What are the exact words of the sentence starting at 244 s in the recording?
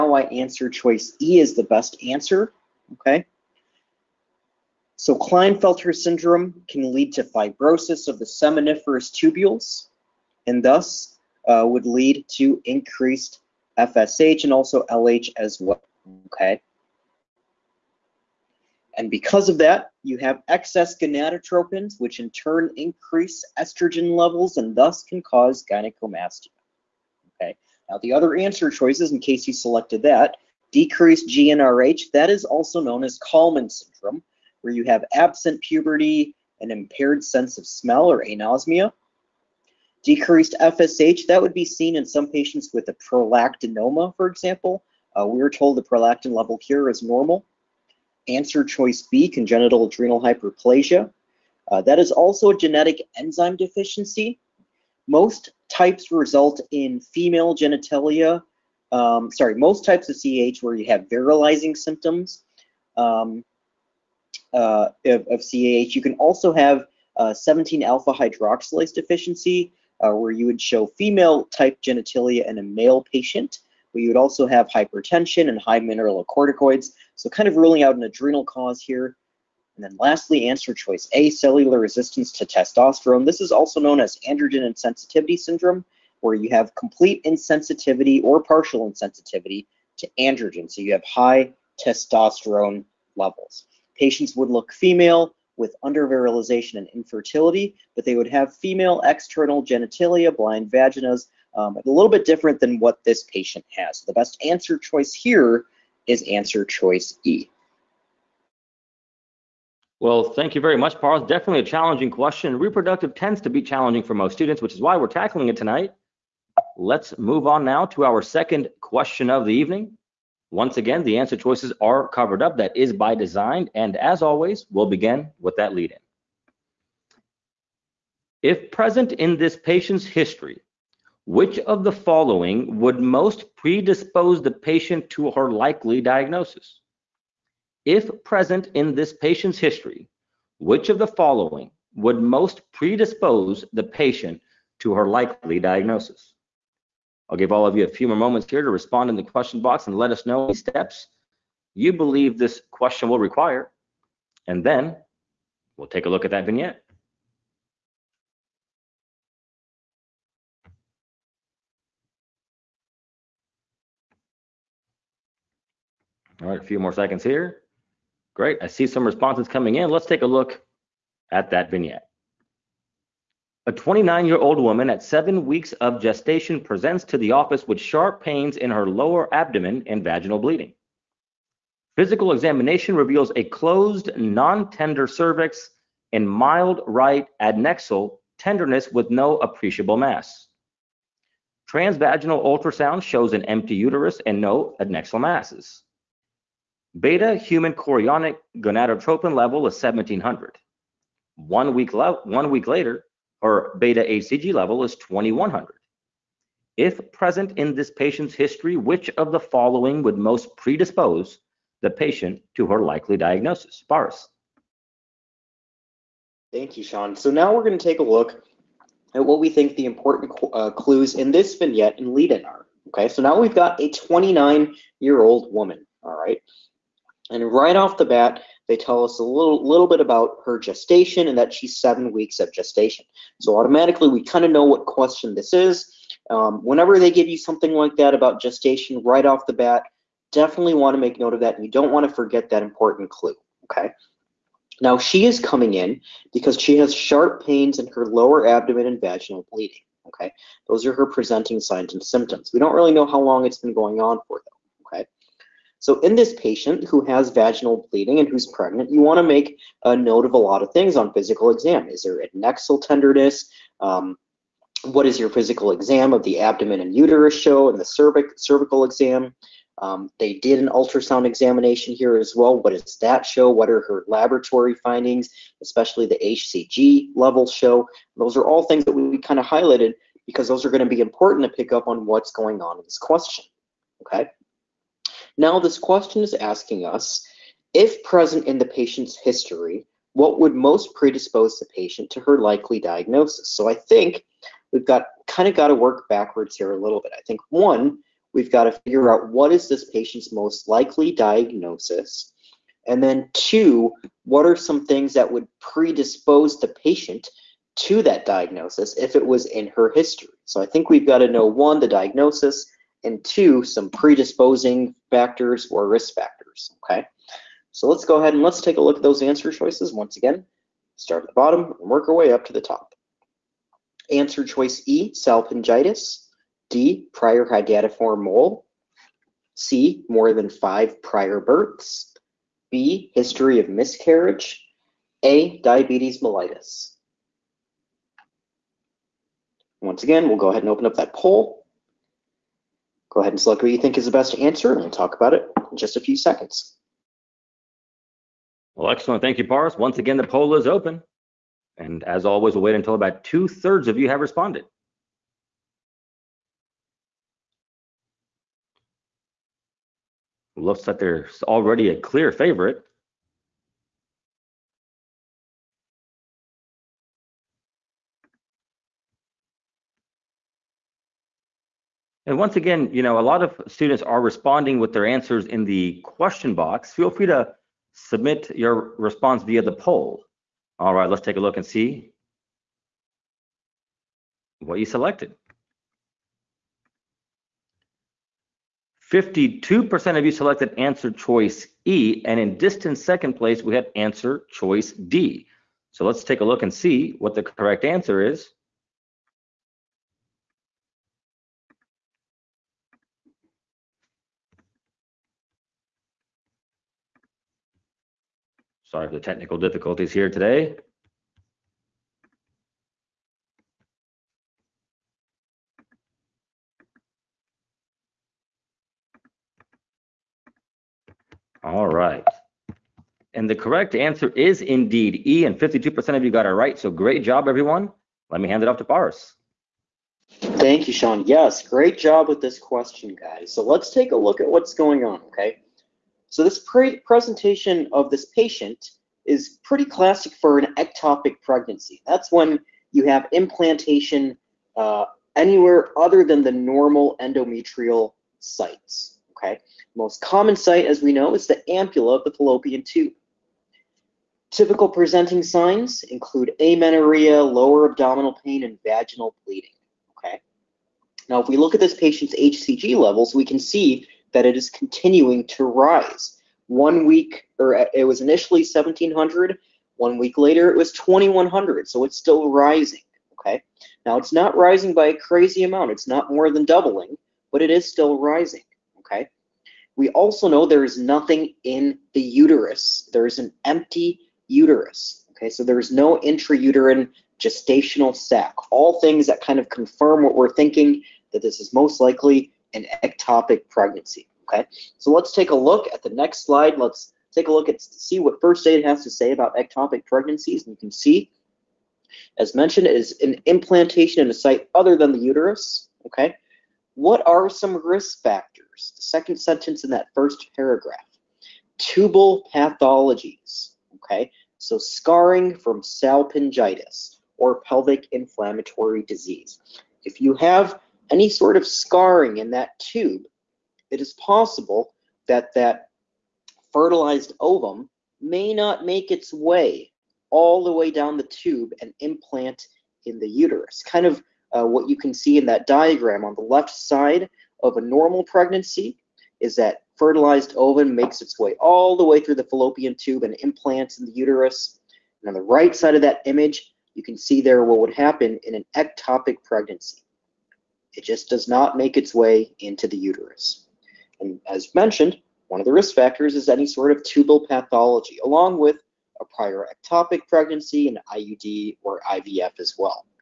Now she is coming in because she has sharp pains in her lower abdomen and vaginal bleeding, okay?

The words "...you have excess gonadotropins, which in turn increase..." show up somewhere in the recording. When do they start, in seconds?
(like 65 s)
20 s.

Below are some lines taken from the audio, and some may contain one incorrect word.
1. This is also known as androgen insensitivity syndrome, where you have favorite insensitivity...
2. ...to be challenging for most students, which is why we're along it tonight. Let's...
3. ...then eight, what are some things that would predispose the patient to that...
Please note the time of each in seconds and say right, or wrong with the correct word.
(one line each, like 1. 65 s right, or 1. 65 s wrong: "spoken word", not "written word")
1. 83 s wrong: "complete", not "favorite"
2. 113 s wrong: "tackling", not "along"
3. 303 s wrong: "two", not "eight".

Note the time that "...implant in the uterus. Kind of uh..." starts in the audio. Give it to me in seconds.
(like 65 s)
531 s.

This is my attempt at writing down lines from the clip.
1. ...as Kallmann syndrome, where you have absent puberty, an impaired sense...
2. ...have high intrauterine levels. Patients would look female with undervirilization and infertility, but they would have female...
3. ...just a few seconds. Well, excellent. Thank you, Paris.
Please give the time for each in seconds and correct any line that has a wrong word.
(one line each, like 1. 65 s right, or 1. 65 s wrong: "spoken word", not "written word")
1. 33 s right
2. 90 s wrong: "testosterone", not "intrauterine"
3. 345 s right.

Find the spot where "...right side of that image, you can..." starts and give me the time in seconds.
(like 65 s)
545 s.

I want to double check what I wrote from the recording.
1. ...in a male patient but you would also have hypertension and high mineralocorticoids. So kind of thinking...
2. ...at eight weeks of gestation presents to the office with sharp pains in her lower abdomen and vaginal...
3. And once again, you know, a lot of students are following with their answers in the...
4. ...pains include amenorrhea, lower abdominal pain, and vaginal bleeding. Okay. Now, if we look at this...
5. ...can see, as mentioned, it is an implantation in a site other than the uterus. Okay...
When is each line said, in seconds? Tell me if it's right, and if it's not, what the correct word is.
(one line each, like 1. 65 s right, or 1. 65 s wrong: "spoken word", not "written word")
1. 72 s wrong: "ruling", not "thinking"
2. 174 s wrong: "seven", not "eight"
3. 372 s wrong: "responding", not "following"
4. 455 s wrong: "signs", not "pains"
5. 500 s right.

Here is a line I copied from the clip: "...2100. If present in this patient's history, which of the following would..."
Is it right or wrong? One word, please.
right.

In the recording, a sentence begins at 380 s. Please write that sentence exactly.
All right, let's take a look and see what you selected.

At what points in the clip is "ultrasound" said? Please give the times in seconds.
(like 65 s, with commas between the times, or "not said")
192 s, 270 s.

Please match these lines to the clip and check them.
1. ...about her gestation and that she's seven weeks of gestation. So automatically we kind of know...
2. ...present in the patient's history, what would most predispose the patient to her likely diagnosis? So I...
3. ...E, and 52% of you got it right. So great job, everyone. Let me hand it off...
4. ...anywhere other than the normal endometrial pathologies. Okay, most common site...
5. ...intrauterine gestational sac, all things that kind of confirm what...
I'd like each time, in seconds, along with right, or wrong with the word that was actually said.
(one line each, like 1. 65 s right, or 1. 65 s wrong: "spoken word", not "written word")
1. 229 s right
2. 288 s right
3. 425 s right
4. 445 s wrong: "sites", not "pathologies"
5. 486 s right.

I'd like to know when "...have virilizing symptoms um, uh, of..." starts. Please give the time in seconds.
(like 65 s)
60 s.